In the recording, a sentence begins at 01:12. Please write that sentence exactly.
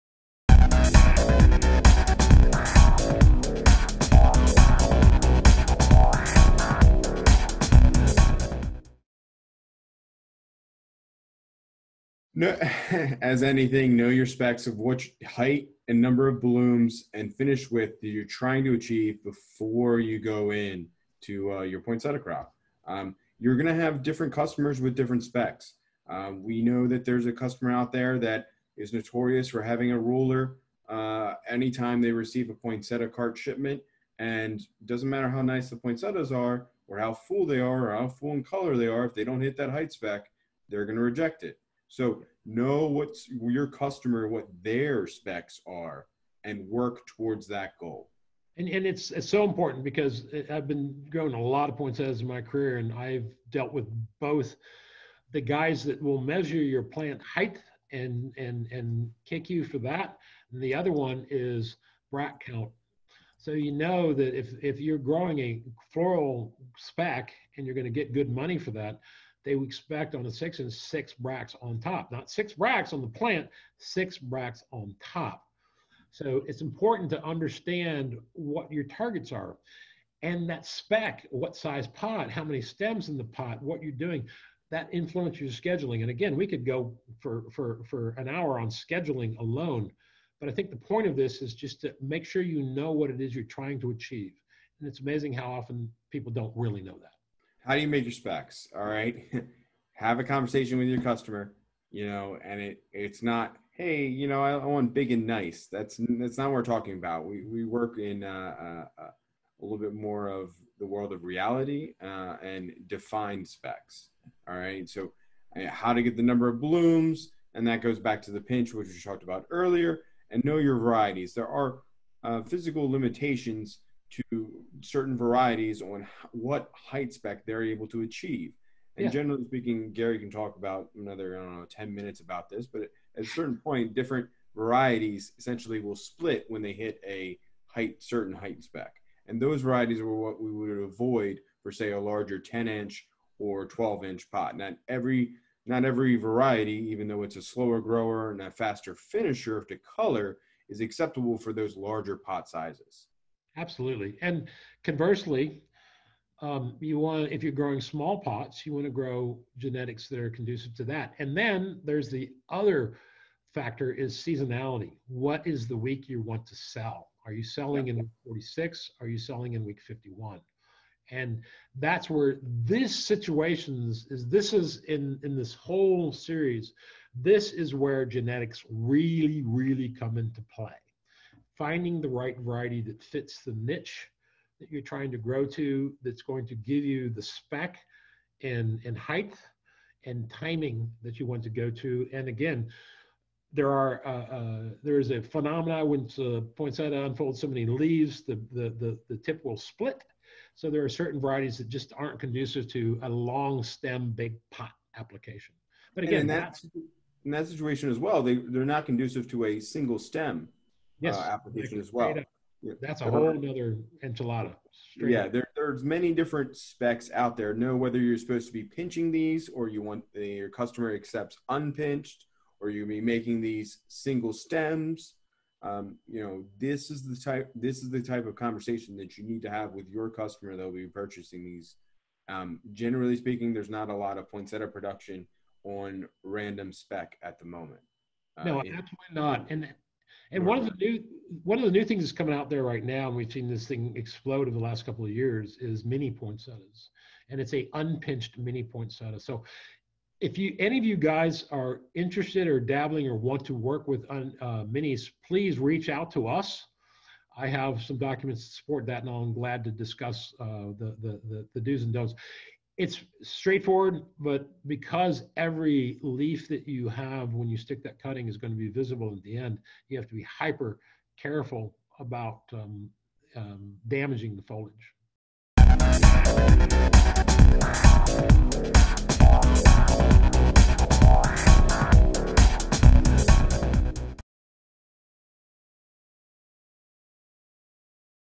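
Not six bracts on the plant, six bracts on top.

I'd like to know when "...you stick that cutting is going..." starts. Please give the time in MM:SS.
04:27.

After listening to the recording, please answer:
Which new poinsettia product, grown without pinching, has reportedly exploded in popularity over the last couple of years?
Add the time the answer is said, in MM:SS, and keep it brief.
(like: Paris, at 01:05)
Mini poinsettias, at 04:05.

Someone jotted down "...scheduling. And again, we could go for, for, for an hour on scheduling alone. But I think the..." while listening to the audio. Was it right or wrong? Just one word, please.
right.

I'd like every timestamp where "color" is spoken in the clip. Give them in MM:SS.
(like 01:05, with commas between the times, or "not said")
00:38, 02:29.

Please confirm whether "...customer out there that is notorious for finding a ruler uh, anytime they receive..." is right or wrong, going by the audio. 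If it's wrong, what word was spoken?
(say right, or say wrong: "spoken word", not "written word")
wrong: "having", not "finding".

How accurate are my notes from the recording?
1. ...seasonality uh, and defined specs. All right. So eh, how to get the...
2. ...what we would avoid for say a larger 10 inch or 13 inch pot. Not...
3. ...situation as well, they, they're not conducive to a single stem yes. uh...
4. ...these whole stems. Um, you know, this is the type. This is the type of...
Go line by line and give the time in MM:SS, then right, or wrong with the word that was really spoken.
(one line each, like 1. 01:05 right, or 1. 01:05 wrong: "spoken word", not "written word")
1. 01:51 wrong: "reality", not "seasonality"
2. 02:20 wrong: "12", not "13"
3. 03:27 right
4. 03:43 wrong: "single", not "whole".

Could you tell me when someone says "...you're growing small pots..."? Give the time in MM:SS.
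02:37.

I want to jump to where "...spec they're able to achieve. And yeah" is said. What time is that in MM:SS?
02:07.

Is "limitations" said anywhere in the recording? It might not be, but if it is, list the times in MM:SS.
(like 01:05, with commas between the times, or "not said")
02:02.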